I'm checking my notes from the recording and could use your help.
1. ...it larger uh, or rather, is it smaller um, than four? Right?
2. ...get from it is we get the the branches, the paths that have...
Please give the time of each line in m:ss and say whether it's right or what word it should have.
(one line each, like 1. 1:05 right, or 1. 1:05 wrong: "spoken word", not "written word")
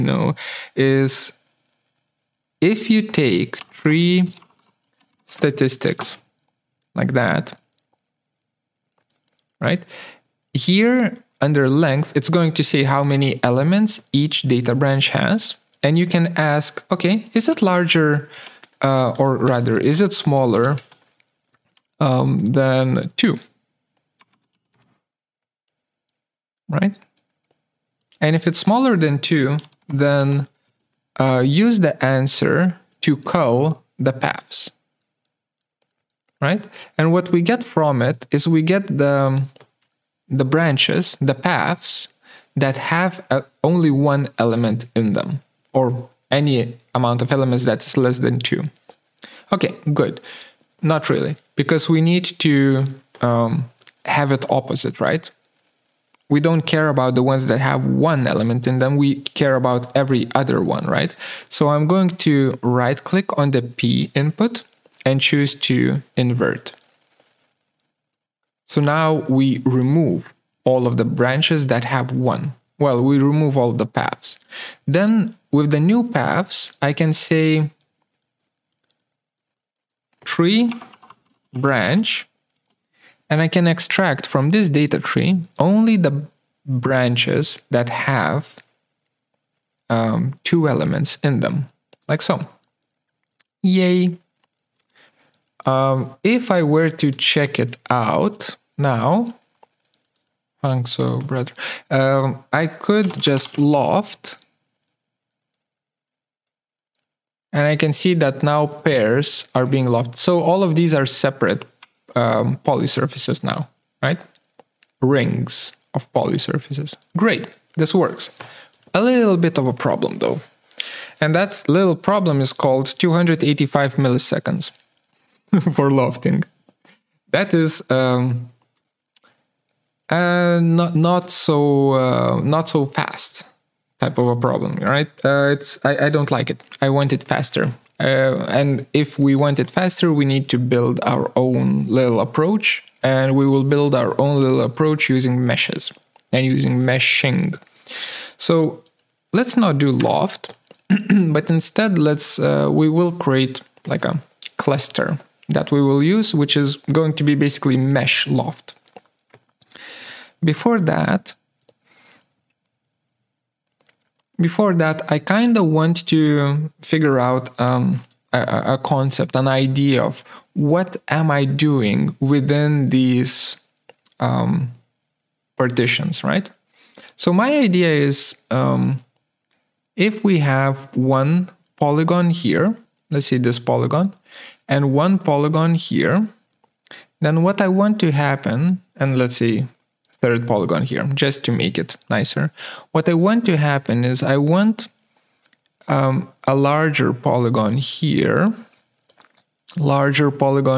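1. 0:17 wrong: "two", not "four"
2. 0:37 right.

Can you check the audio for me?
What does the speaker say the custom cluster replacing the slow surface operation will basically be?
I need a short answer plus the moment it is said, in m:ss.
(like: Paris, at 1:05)
mesh loft, at 2:37.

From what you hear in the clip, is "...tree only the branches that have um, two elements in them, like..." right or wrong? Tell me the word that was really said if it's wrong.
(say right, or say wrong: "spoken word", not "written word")
right.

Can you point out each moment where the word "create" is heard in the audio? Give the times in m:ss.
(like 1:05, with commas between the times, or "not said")
2:33.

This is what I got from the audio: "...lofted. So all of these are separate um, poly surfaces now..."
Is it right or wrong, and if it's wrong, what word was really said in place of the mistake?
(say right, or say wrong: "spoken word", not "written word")
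right.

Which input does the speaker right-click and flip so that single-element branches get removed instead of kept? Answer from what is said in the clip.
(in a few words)
P input.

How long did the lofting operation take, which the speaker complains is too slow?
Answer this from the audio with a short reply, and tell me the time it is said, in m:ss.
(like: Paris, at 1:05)
285 milliseconds, at 2:02.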